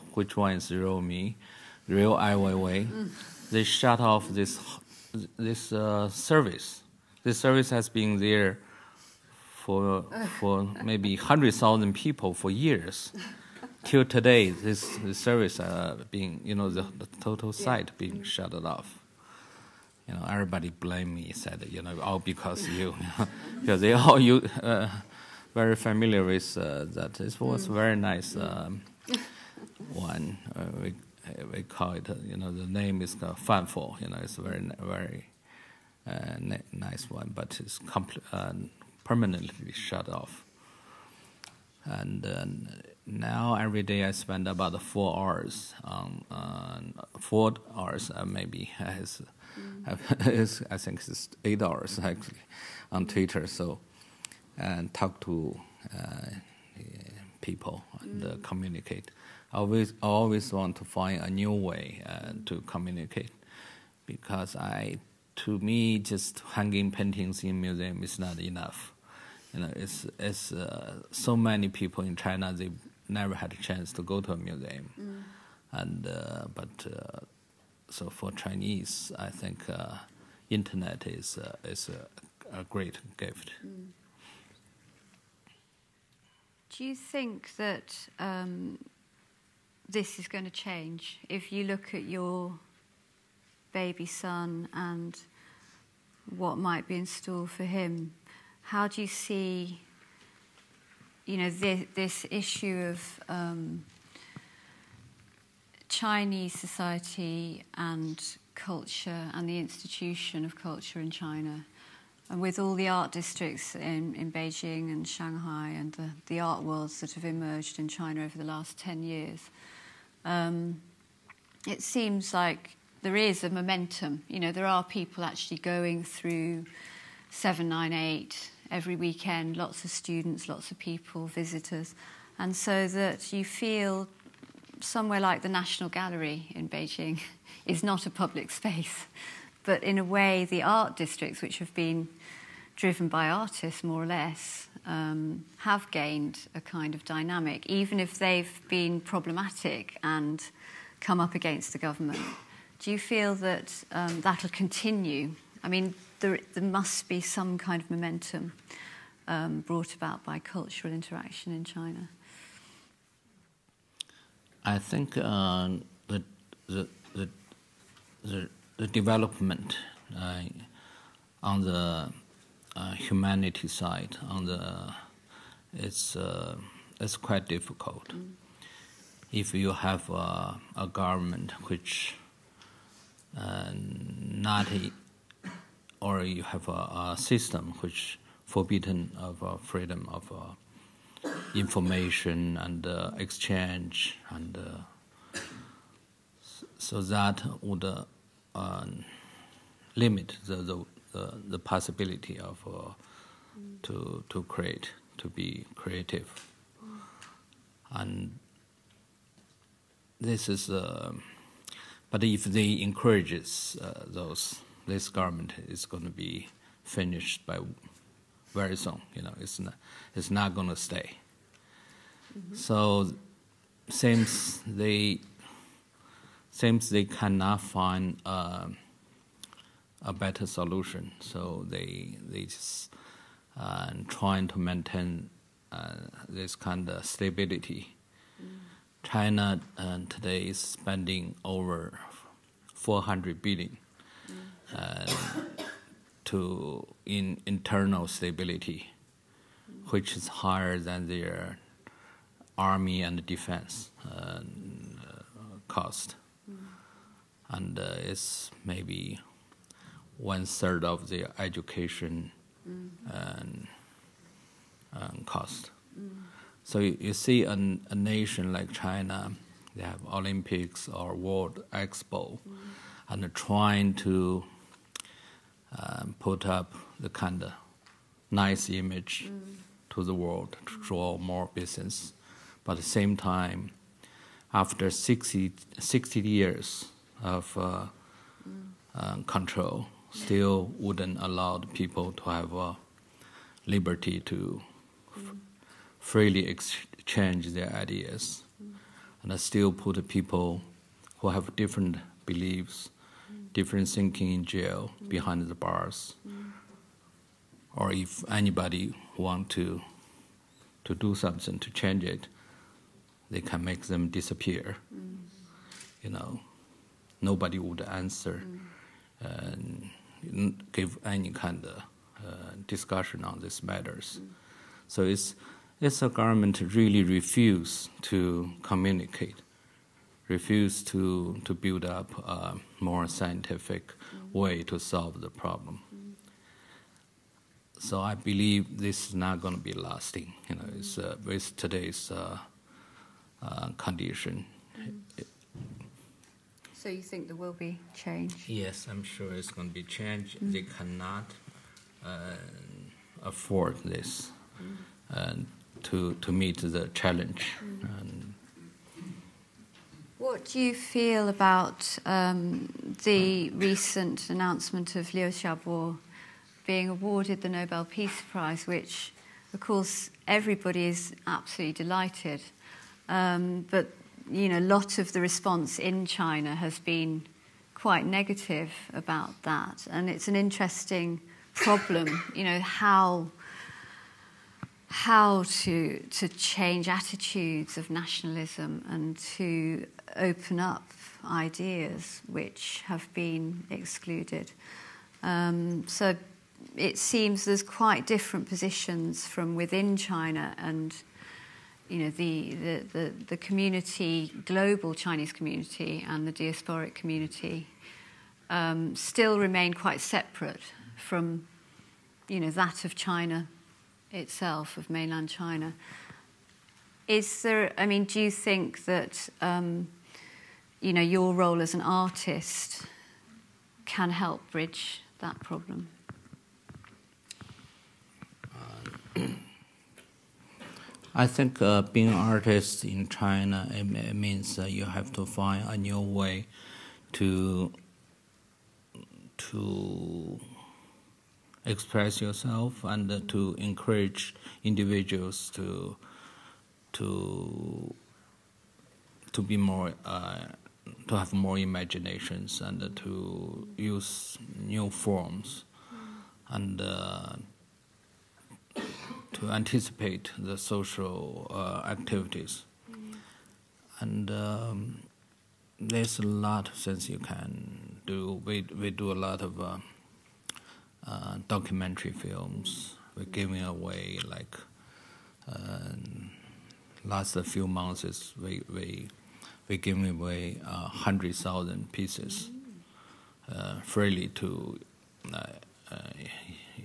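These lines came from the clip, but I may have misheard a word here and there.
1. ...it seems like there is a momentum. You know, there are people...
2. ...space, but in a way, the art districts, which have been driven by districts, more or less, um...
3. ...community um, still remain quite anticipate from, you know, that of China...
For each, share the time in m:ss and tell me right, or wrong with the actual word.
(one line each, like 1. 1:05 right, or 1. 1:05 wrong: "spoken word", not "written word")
1. 2:01 right
2. 2:18 wrong: "artists", not "districts"
3. 6:46 wrong: "separate", not "anticipate".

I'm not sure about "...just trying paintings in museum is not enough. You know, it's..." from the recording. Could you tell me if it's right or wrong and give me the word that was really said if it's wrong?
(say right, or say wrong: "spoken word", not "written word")
wrong: "hanging", not "trying".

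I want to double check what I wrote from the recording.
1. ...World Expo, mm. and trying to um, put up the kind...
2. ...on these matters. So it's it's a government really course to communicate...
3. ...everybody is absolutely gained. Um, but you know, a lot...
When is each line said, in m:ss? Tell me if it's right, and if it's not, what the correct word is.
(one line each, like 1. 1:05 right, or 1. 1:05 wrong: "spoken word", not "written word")
1. 4:31 right
2. 5:23 wrong: "refuse", not "course"
3. 6:10 wrong: "delighted", not "gained".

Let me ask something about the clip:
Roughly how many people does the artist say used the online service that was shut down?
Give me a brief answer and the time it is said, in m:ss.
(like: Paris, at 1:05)
100,000, at 0:11.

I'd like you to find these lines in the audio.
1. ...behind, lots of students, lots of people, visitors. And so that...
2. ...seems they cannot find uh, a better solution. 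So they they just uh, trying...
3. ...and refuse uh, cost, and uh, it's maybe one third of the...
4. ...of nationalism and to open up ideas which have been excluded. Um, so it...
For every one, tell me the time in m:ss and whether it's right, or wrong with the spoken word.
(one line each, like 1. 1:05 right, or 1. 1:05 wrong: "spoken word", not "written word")
1. 2:08 wrong: "weekend", not "behind"
2. 3:46 right
3. 4:13 wrong: "defense", not "refuse"
4. 6:27 right.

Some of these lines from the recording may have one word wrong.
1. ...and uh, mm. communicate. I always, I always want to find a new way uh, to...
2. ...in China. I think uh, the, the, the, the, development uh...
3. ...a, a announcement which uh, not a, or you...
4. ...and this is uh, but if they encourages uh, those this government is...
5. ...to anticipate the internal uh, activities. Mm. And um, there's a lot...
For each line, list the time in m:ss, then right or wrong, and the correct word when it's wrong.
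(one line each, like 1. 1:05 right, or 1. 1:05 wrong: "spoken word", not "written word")
1. 0:57 right
2. 2:41 right
3. 3:00 wrong: "government", not "announcement"
4. 3:27 right
5. 7:39 wrong: "social", not "internal".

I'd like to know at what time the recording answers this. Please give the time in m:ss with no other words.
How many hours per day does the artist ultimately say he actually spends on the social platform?
0:51.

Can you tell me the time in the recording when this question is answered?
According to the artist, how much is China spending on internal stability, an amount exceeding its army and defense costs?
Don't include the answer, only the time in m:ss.
4:01.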